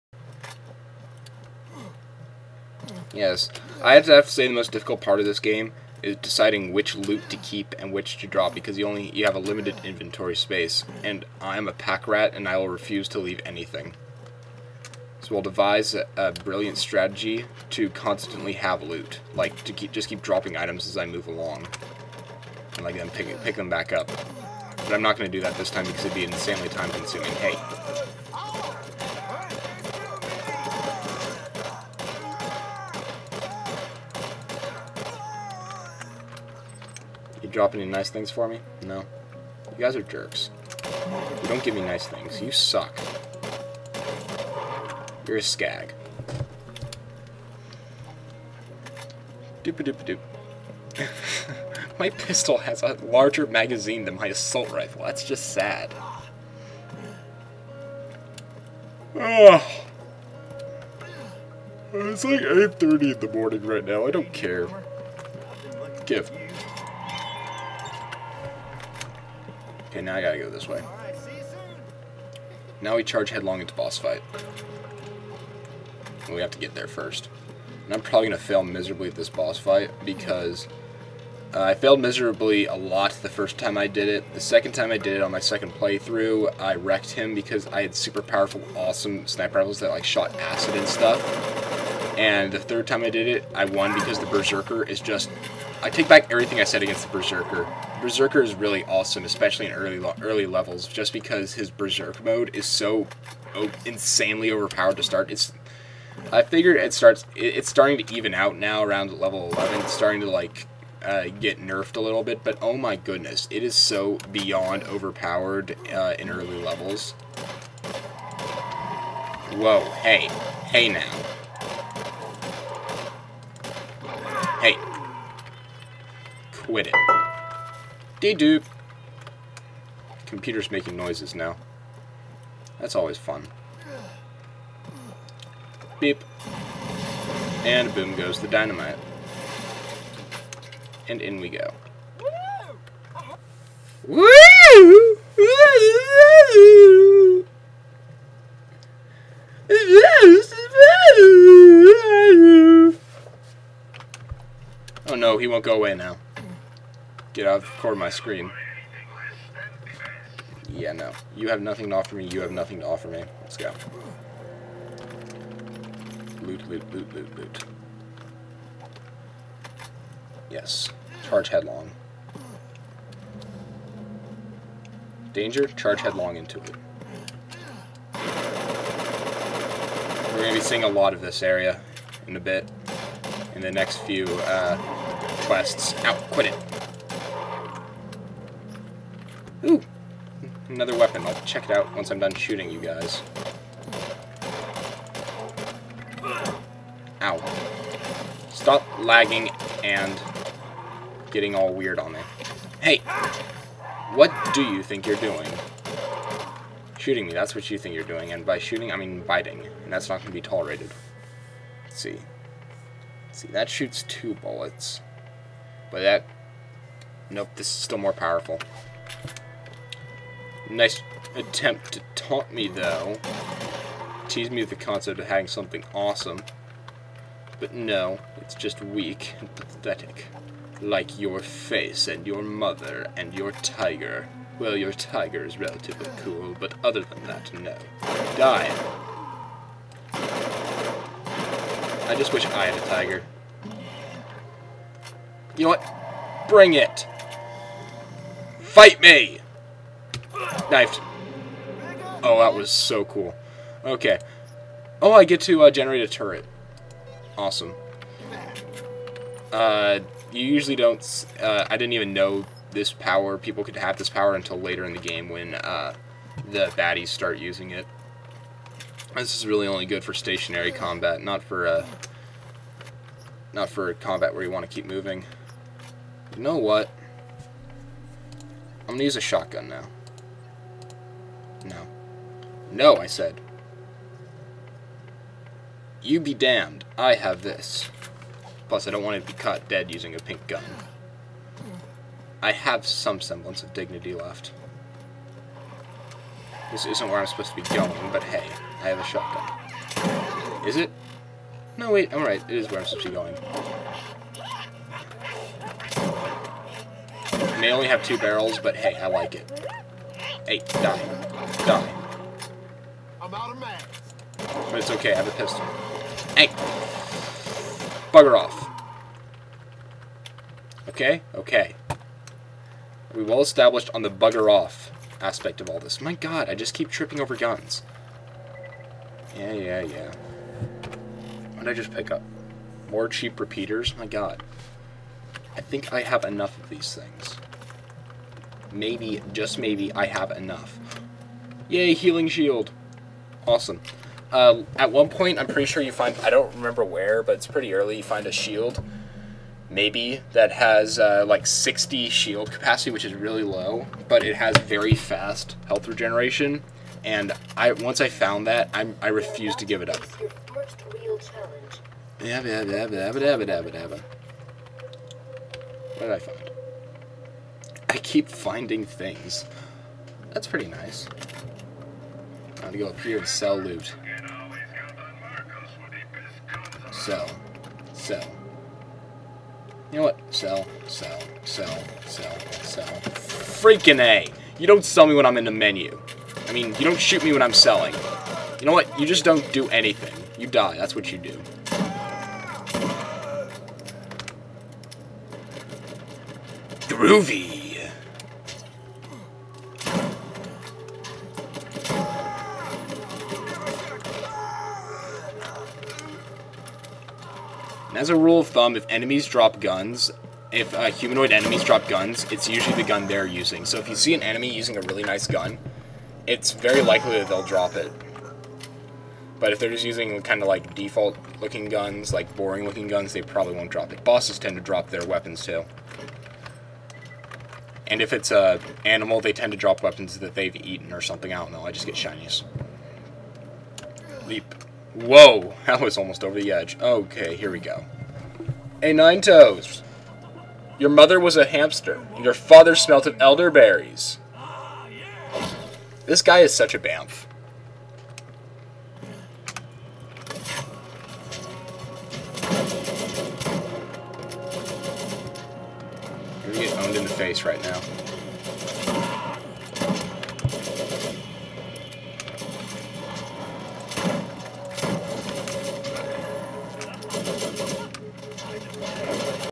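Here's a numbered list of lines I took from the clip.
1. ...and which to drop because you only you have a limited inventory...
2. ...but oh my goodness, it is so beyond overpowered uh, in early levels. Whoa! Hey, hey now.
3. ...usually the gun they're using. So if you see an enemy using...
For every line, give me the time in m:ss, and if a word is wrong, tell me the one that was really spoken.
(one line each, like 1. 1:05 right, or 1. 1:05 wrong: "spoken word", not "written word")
1. 0:07 right
2. 1:52 right
3. 6:52 right.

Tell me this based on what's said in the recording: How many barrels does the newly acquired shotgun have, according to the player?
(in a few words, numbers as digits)
2.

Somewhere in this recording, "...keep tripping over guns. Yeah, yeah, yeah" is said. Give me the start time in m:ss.
5:26.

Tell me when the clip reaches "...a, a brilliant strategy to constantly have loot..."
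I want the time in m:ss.
0:15.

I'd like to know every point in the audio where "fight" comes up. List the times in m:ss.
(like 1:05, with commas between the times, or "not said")
1:13, 1:19, 4:08.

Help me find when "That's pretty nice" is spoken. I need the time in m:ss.
6:10.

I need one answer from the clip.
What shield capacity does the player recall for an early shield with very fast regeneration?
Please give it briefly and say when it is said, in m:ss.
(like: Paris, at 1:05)
60, at 5:51.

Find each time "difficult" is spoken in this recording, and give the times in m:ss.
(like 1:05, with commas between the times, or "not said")
0:04.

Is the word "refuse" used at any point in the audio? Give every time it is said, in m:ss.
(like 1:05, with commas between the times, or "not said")
0:12, 5:59.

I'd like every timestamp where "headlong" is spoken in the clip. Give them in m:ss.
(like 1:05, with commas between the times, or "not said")
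1:13, 2:51, 2:56.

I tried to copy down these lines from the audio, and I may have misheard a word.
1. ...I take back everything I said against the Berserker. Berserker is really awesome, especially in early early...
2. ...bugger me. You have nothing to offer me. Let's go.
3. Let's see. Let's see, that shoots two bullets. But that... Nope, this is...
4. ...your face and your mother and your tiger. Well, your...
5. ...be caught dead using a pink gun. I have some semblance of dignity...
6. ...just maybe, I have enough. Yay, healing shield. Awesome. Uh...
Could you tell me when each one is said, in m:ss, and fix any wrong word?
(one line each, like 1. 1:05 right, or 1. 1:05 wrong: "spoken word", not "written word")
1. 1:35 right
2. 2:41 wrong: "offer", not "bugger"
3. 3:31 right
4. 3:51 right
5. 4:49 right
6. 5:39 right.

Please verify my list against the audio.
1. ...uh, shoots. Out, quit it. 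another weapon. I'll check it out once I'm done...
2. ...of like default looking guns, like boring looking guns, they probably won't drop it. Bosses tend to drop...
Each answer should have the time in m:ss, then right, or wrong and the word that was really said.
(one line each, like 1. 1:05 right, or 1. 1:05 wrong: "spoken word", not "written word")
1. 3:04 wrong: "quests", not "shoots"
2. 7:00 right.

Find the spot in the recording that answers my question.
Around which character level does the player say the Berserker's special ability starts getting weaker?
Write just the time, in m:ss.
1:49.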